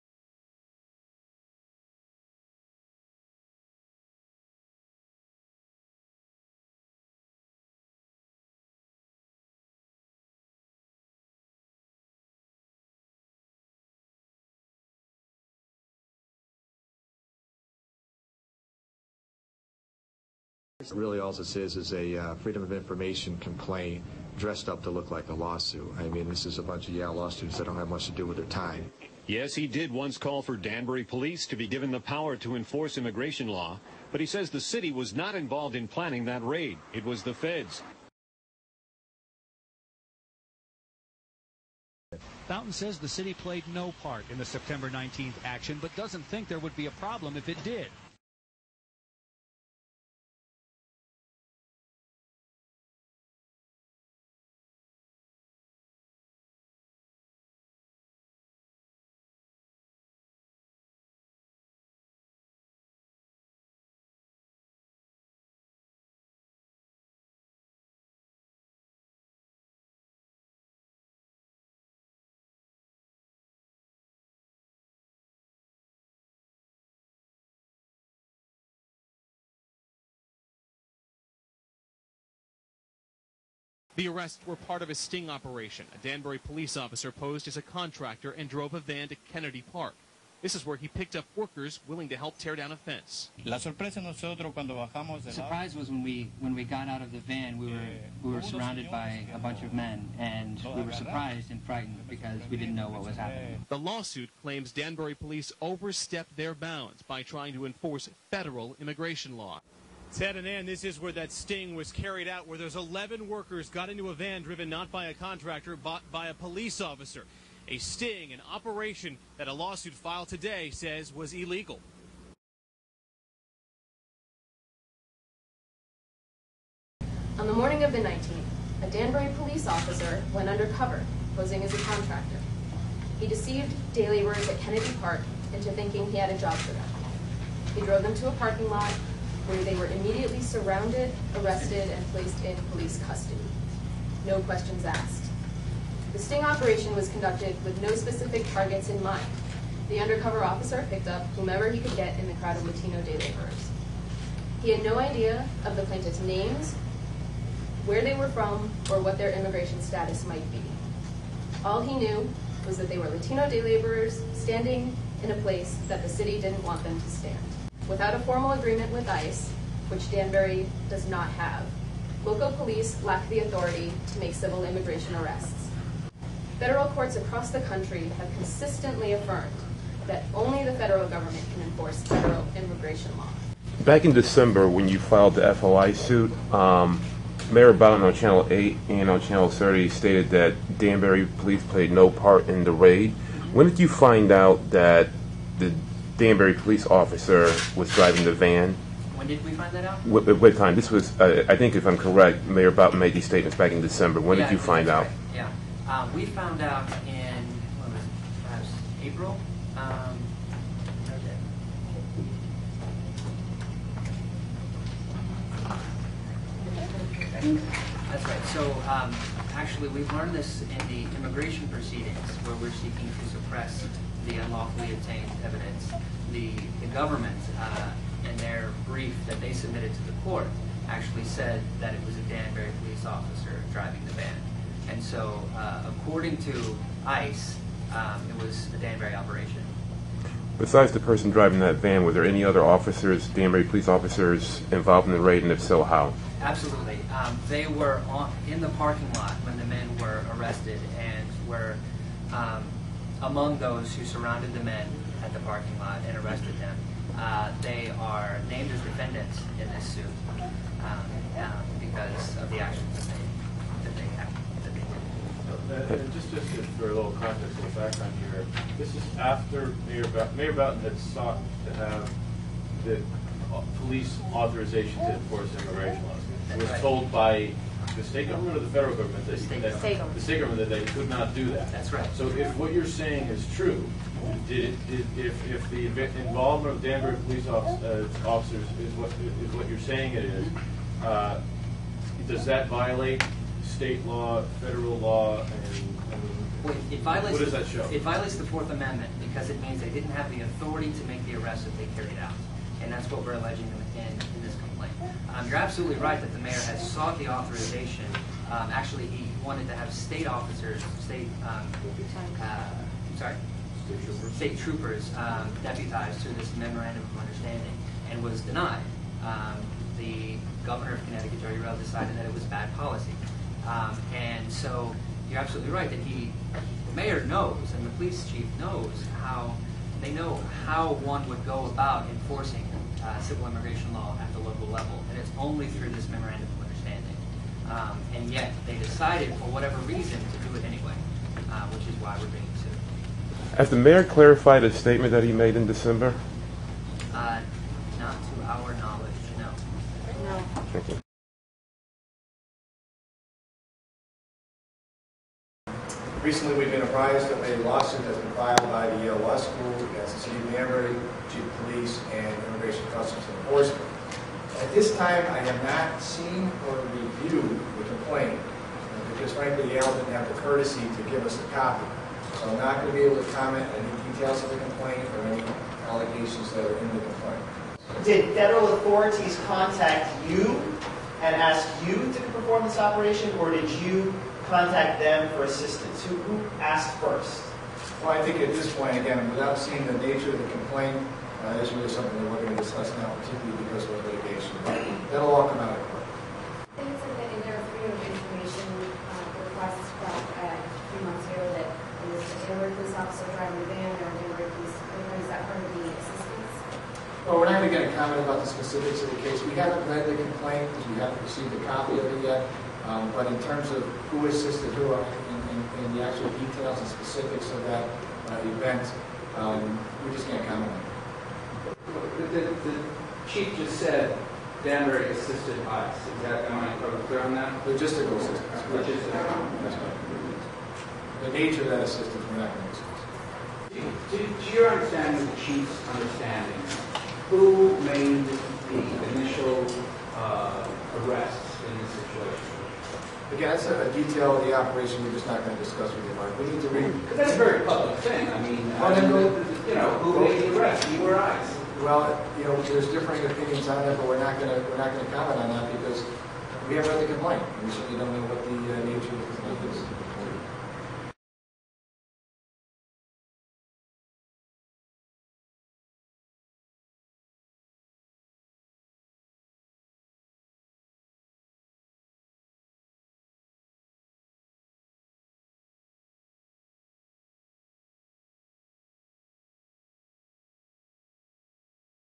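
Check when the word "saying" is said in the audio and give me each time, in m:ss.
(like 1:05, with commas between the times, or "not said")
4:42, 4:49.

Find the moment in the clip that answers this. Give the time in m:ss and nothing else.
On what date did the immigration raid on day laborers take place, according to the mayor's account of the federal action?
0:44.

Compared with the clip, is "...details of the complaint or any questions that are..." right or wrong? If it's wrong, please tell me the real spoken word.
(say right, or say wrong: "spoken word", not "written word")
wrong: "allegations", not "questions".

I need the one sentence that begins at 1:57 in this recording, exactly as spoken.
A sting, an operation that a lawsuit filed today says was illegal.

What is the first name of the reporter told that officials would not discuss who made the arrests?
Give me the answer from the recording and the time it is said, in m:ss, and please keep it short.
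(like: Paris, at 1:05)
Mark, at 7:26.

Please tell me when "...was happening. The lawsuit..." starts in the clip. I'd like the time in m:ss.
1:43.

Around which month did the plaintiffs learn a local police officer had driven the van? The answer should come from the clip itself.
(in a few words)
April.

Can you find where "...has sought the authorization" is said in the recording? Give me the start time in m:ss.
5:06.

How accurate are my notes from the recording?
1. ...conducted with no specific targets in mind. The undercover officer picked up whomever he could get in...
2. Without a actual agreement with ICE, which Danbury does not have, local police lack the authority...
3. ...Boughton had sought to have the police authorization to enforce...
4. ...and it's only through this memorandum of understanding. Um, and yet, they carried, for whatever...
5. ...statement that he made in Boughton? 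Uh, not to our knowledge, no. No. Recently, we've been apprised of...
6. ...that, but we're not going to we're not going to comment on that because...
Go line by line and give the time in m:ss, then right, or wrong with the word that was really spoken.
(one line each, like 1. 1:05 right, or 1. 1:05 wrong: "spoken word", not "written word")
1. 2:27 right
2. 2:47 wrong: "formal", not "actual"
3. 4:30 right
4. 5:35 wrong: "decided", not "carried"
5. 5:44 wrong: "December", not "Boughton"
6. 7:33 right.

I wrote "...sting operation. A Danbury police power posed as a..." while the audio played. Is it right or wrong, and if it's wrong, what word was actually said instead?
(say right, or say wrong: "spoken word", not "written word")
wrong: "officer", not "power".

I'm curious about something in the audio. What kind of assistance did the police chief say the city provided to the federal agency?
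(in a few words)
Logistical assistance.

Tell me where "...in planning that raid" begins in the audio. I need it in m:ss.
0:35.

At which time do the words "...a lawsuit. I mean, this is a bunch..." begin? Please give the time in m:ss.
0:25.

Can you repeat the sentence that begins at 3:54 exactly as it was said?
And so, uh, according to ICE, um, it was a Danbury operation.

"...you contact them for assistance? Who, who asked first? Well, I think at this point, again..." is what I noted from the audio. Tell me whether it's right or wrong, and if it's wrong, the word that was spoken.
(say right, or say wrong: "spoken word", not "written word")
right.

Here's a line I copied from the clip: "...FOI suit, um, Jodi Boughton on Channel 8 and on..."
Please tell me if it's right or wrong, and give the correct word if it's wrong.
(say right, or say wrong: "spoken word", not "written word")
wrong: "Mayor", not "Jodi".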